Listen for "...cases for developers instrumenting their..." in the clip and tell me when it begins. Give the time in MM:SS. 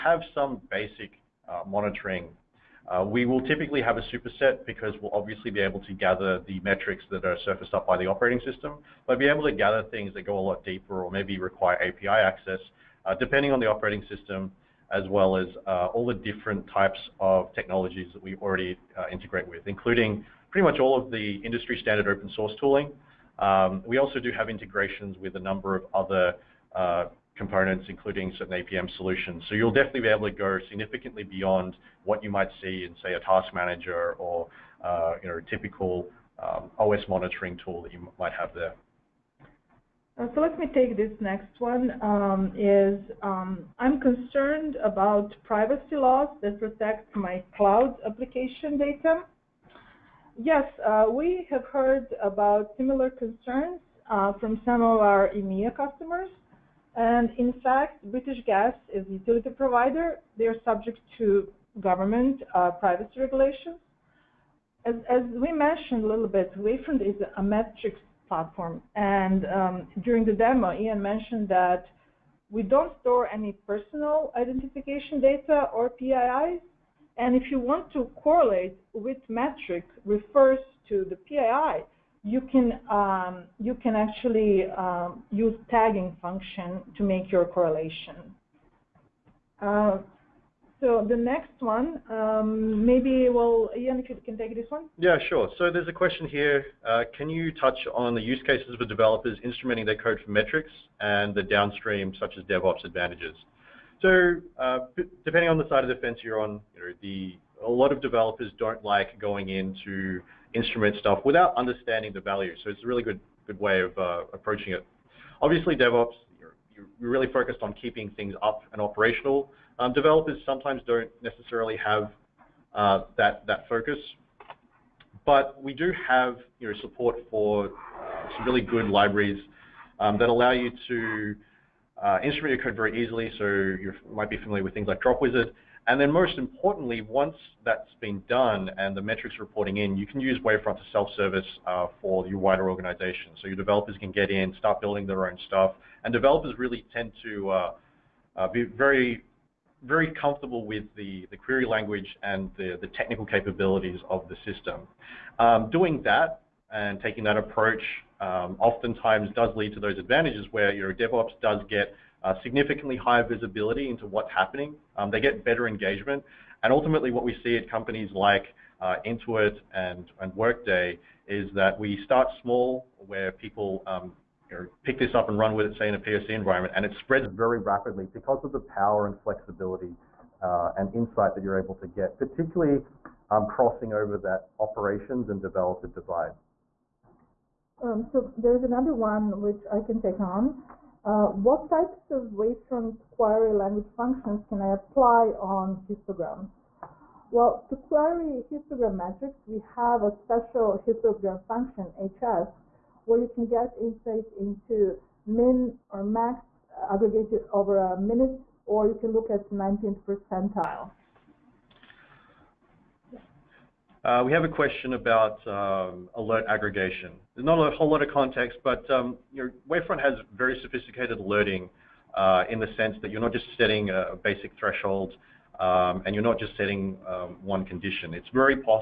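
01:38.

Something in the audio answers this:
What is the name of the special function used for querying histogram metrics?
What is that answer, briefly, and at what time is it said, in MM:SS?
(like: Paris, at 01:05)
HS, at 03:21.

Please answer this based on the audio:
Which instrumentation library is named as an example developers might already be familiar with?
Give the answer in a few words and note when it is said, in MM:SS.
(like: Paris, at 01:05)
Dropwizard, at 02:15.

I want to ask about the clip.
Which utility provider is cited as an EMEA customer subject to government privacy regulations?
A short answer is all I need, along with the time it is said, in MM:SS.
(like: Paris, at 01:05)
British Gas, at 00:58.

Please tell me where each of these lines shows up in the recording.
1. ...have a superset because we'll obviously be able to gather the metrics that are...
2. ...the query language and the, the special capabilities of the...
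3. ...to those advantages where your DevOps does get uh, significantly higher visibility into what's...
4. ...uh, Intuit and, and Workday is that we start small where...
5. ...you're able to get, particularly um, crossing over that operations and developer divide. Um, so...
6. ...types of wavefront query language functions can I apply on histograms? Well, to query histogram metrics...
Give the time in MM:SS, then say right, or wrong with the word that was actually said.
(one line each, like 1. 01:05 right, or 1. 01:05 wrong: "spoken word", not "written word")
1. 00:03 right
2. 02:31 wrong: "technical", not "special"
3. 02:39 right
4. 02:48 right
5. 03:01 right
6. 03:11 right.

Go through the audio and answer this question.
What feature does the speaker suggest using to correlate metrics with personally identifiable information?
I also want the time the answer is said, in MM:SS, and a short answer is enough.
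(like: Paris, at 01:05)
Tagging function, at 01:25.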